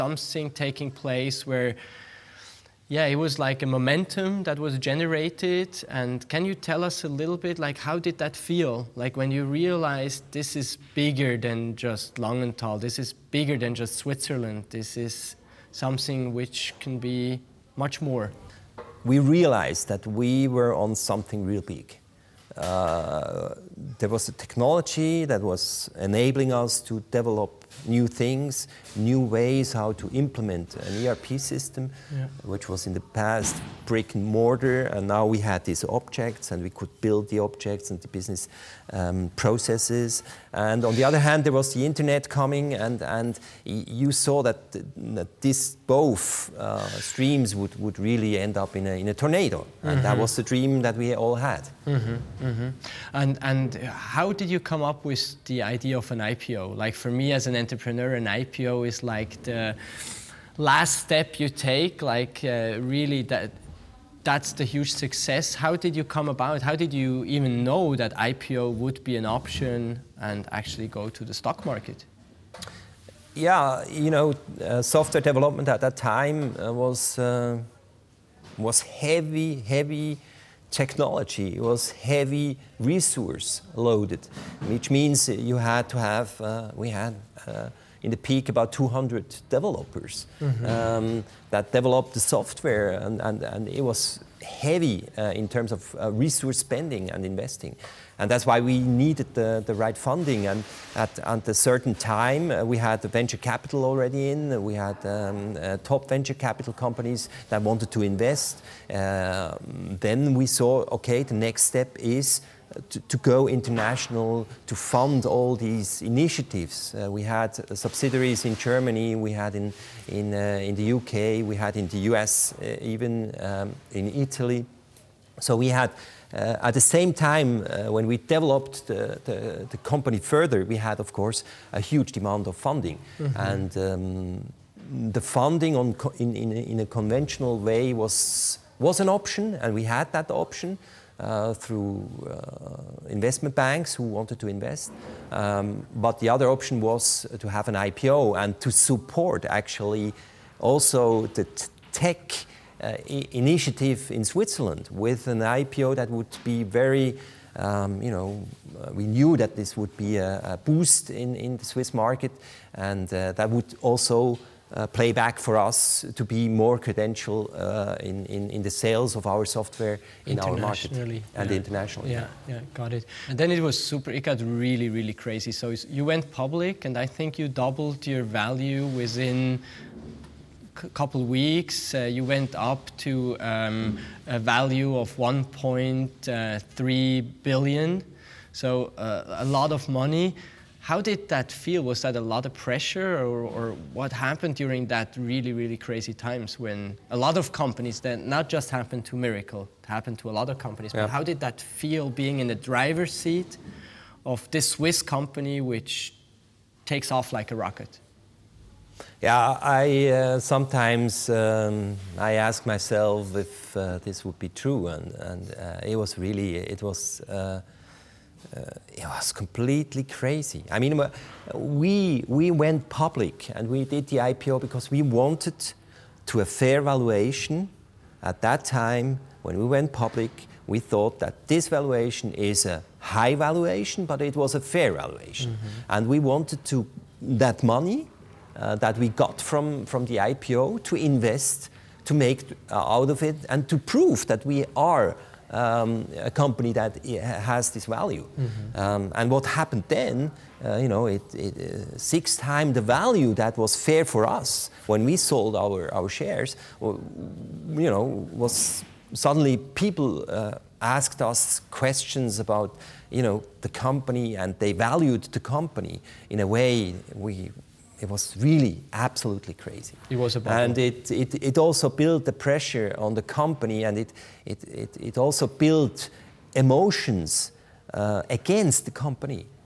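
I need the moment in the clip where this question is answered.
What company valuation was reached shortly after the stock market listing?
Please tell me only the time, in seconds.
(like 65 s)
185 s.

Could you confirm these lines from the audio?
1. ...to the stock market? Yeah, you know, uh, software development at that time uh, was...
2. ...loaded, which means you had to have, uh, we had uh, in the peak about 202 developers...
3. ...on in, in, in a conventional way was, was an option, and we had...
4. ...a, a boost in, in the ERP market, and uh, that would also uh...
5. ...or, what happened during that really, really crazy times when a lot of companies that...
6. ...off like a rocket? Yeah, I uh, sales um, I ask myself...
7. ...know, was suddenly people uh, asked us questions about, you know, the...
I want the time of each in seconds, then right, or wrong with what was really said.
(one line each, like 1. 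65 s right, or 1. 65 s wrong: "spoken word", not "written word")
1. 71 s right
2. 83 s wrong: "200", not "202"
3. 135 s right
4. 160 s wrong: "Swiss", not "ERP"
5. 193 s right
6. 207 s wrong: "sometimes", not "sales"
7. 257 s right.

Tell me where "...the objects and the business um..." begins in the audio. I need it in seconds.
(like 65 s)
37 s.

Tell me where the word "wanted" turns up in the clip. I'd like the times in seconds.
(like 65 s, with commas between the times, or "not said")
107 s, 144 s, 225 s, 236 s.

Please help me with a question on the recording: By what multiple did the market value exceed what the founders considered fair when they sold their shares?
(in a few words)
6 times.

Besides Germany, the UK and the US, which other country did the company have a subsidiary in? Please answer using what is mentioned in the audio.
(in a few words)
Italy.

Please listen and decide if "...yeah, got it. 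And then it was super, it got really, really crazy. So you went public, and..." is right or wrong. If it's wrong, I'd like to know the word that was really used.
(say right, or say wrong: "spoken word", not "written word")
right.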